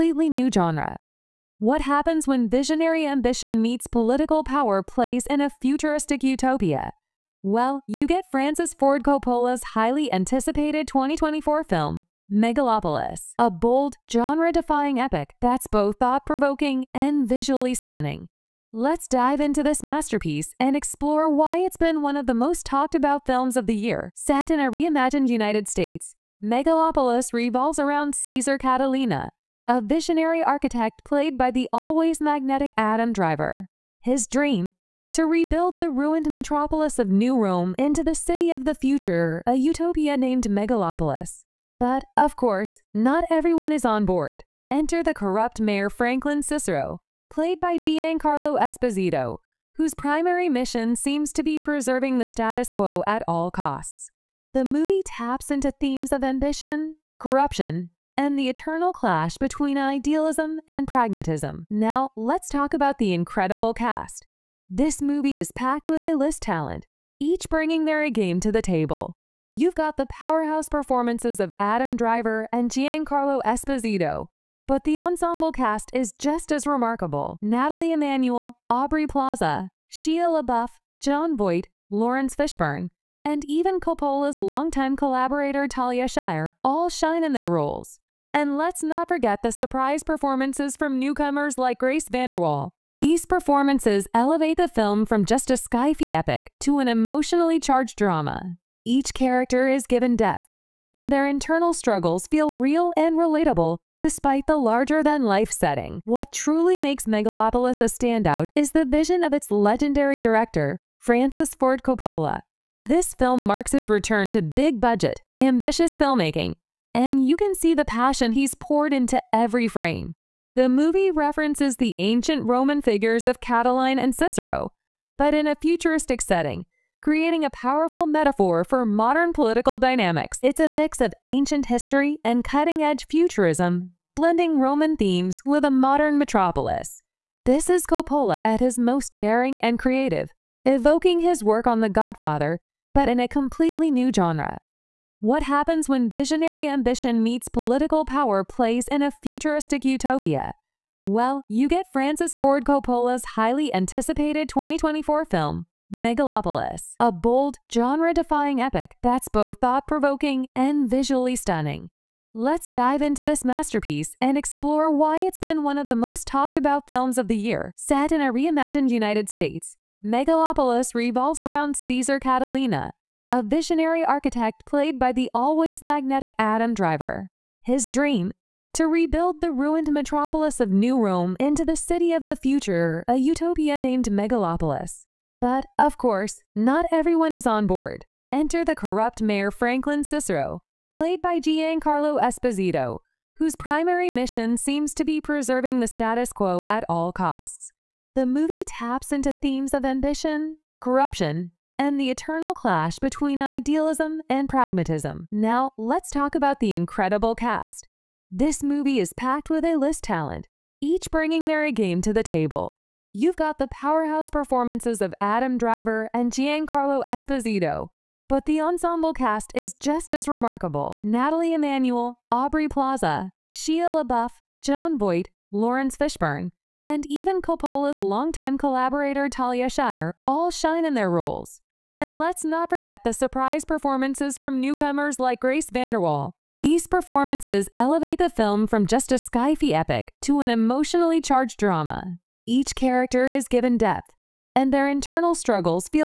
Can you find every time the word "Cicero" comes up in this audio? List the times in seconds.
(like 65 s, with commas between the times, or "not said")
46 s, 124 s, 190 s.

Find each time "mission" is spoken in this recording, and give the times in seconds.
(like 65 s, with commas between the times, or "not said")
50 s, 194 s.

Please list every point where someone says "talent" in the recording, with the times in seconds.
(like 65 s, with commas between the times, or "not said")
66 s, 210 s.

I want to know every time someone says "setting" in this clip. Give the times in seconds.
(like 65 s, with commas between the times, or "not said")
105 s, 126 s.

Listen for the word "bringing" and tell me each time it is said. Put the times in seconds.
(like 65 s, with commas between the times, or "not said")
67 s, 211 s.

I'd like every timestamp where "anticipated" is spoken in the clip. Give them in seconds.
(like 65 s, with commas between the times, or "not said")
10 s, 153 s.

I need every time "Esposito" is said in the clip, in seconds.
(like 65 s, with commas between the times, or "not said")
48 s, 73 s, 192 s, 217 s.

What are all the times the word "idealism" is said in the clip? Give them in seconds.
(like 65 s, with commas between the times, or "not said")
59 s, 203 s.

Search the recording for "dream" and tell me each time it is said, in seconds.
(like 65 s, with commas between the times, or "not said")
34 s, 177 s.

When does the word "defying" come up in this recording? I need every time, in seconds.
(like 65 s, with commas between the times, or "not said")
14 s, 157 s.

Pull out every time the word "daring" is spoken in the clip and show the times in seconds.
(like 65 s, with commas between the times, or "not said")
139 s.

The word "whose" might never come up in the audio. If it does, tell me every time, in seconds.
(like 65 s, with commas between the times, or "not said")
49 s, 193 s.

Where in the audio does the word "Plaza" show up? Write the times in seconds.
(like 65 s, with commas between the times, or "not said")
79 s, 222 s.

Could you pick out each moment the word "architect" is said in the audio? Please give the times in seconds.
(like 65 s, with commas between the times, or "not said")
30 s, 174 s.